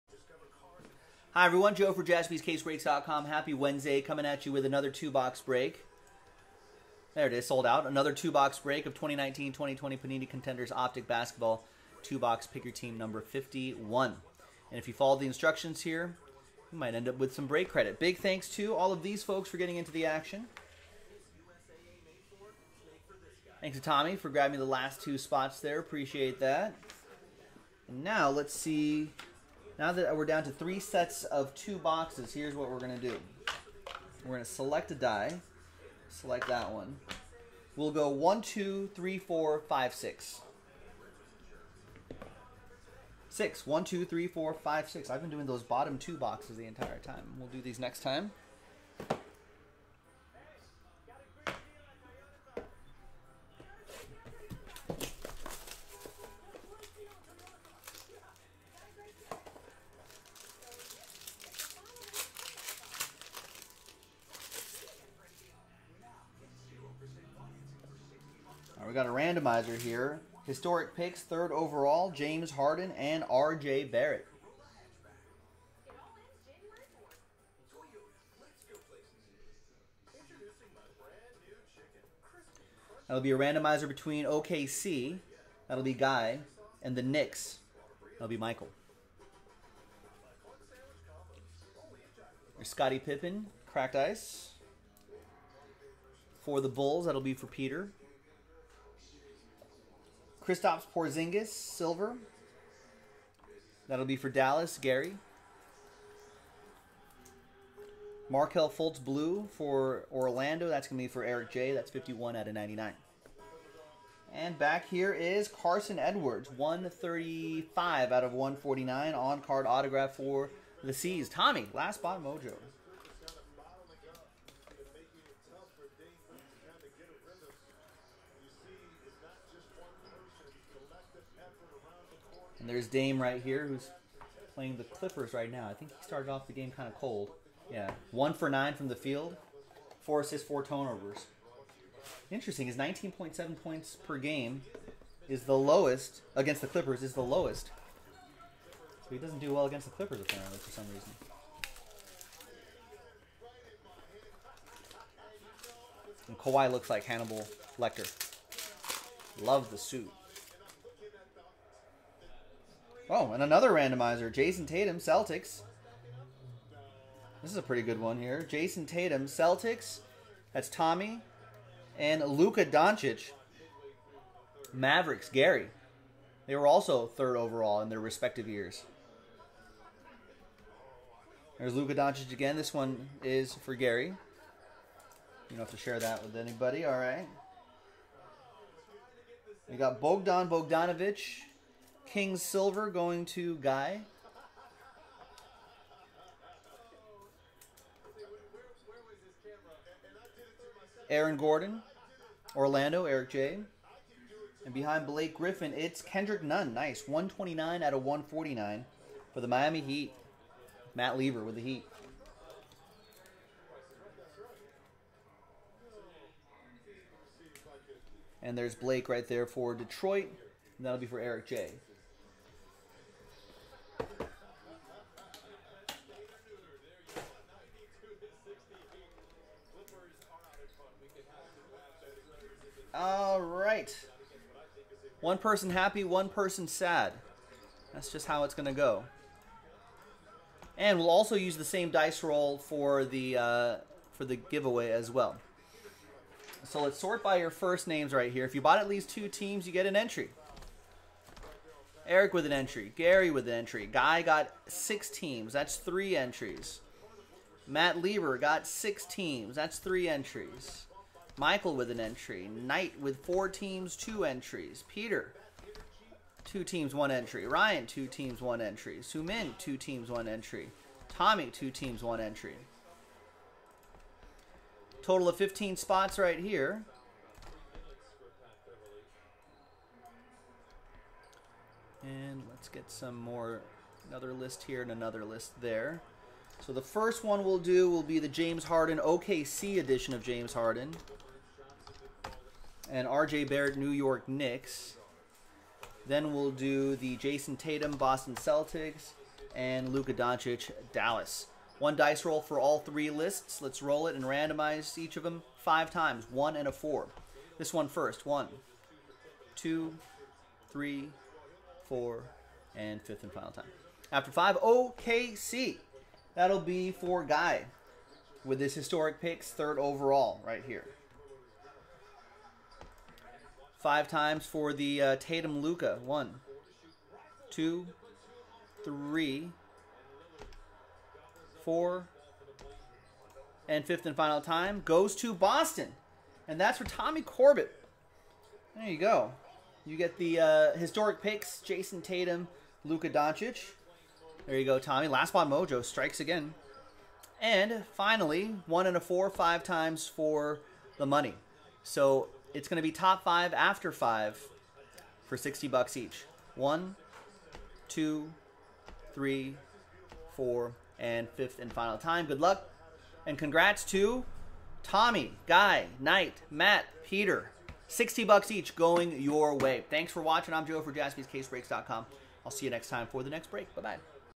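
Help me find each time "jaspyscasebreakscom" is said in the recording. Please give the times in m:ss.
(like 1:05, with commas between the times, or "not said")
0:02, 6:10.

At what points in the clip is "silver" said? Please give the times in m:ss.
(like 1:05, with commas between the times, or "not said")
1:41, 3:12.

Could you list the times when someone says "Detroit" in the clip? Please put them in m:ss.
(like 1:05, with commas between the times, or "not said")
3:39.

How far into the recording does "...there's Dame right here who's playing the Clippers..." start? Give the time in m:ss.
2:12.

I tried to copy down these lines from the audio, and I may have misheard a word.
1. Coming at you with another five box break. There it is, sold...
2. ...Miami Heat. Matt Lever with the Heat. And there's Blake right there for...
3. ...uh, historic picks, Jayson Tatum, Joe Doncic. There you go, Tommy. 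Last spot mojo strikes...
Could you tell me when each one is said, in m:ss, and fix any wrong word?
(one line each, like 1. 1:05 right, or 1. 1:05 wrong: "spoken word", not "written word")
1. 0:04 wrong: "two", not "five"
2. 3:29 right
3. 5:40 wrong: "Luka", not "Joe".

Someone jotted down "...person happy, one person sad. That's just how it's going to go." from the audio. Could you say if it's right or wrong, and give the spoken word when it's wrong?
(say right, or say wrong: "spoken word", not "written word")
right.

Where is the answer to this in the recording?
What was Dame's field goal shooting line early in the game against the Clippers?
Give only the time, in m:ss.
2:18.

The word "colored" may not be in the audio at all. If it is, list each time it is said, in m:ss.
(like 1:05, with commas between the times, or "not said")
not said.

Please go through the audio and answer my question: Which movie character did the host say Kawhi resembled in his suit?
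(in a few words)
Hannibal Lecter.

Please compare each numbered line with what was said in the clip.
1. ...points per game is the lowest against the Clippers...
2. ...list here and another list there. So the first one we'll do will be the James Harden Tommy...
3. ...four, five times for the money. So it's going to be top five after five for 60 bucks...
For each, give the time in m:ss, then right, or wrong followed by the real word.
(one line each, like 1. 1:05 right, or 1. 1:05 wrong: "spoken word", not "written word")
1. 2:23 right
2. 4:44 wrong: "OKC", not "Tommy"
3. 5:48 right.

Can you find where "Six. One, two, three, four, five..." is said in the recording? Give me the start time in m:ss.
0:43.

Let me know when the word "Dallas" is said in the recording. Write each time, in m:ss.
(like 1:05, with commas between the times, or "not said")
1:44, 5:00.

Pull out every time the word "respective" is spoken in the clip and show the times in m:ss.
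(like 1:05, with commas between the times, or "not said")
2:57.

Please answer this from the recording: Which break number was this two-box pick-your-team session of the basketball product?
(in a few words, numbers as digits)
51.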